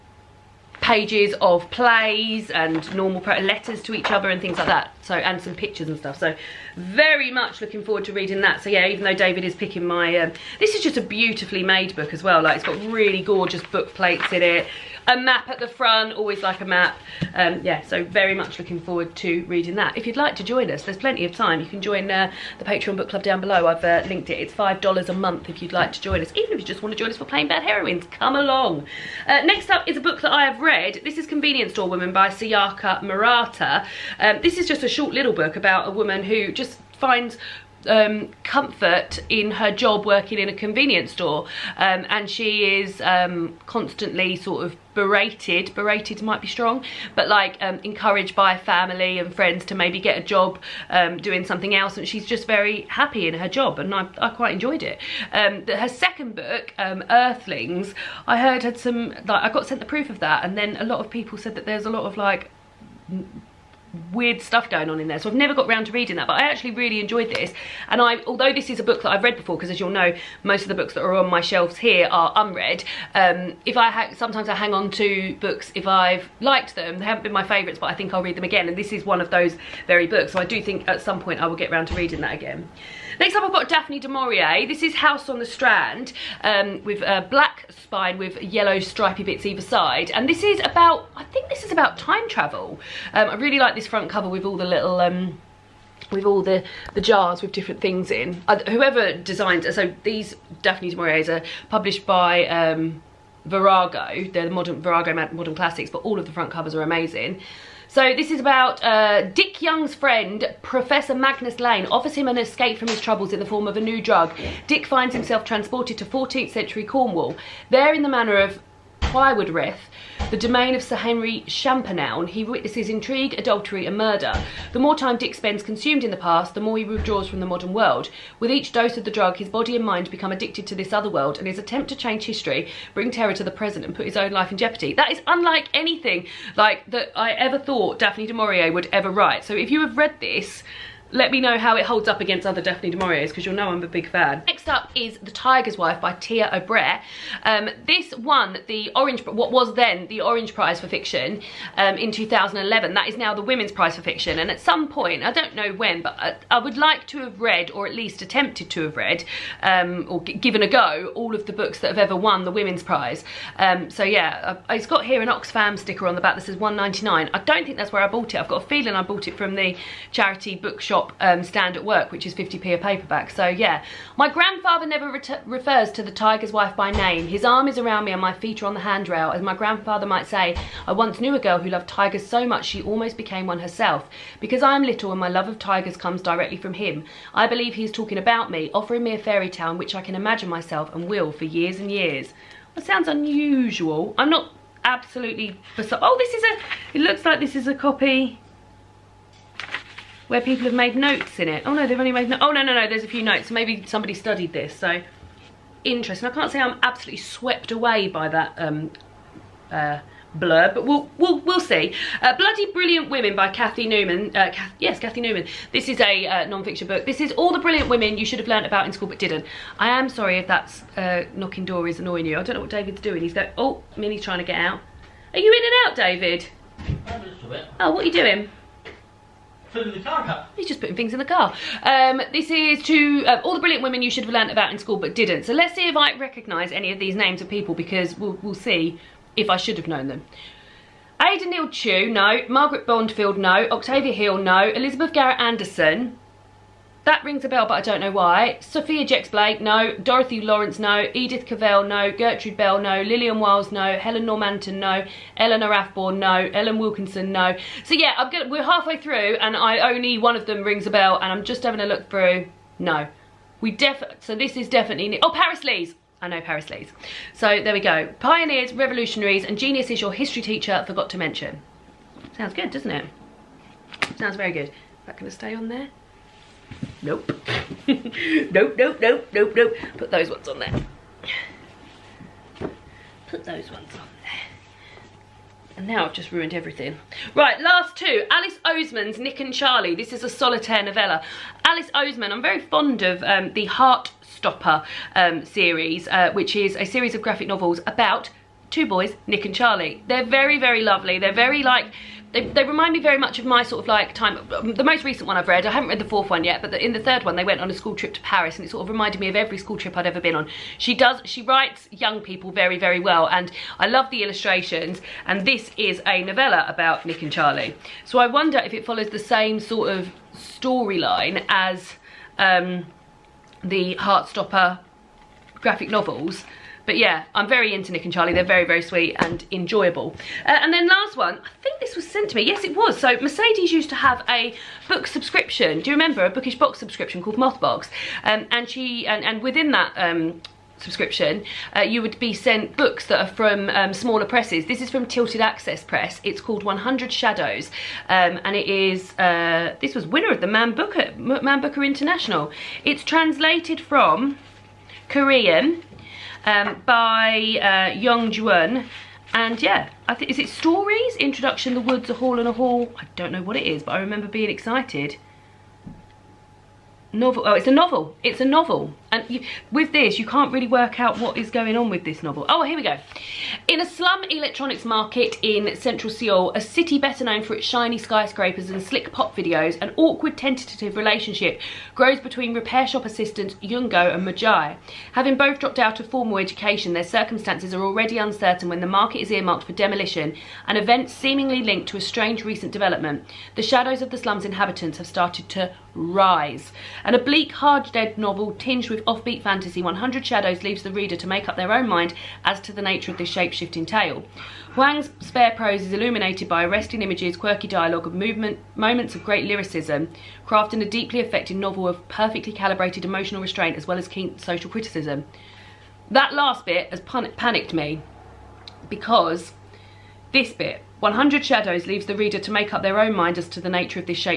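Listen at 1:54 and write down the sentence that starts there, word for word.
Dick finds himself transported to 14th century Cornwall.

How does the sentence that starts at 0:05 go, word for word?
So, and some pictures and stuff.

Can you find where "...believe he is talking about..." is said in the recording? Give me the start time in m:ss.
3:07.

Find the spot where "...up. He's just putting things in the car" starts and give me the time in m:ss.
3:50.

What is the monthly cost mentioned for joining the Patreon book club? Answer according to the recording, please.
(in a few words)
$5.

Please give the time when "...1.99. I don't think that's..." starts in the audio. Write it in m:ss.
2:46.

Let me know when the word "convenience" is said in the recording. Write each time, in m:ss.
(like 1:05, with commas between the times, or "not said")
0:31, 0:40.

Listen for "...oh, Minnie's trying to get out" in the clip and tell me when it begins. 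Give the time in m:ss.
3:43.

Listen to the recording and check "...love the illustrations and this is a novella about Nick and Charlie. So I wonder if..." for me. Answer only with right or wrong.
right.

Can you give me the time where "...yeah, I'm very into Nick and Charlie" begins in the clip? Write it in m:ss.
5:26.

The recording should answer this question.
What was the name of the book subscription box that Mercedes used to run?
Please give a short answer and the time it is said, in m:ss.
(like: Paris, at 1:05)
Mothbox, at 5:37.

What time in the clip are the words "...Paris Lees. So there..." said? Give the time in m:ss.
4:26.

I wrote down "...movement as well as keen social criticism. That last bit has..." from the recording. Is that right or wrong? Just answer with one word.
wrong.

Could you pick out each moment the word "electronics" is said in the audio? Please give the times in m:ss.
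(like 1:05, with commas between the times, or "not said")
6:14.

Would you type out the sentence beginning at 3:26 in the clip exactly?
I can't say I'm absolutely swept away by that um, uh, blurb, but we'll, we'll, we'll see.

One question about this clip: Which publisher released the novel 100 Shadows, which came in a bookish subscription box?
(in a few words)
Tilted Axis Press.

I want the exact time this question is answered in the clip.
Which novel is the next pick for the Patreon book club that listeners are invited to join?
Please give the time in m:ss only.
0:27.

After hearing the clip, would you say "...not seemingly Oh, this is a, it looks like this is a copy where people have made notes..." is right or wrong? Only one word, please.
wrong.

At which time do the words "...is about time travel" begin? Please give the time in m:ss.
1:31.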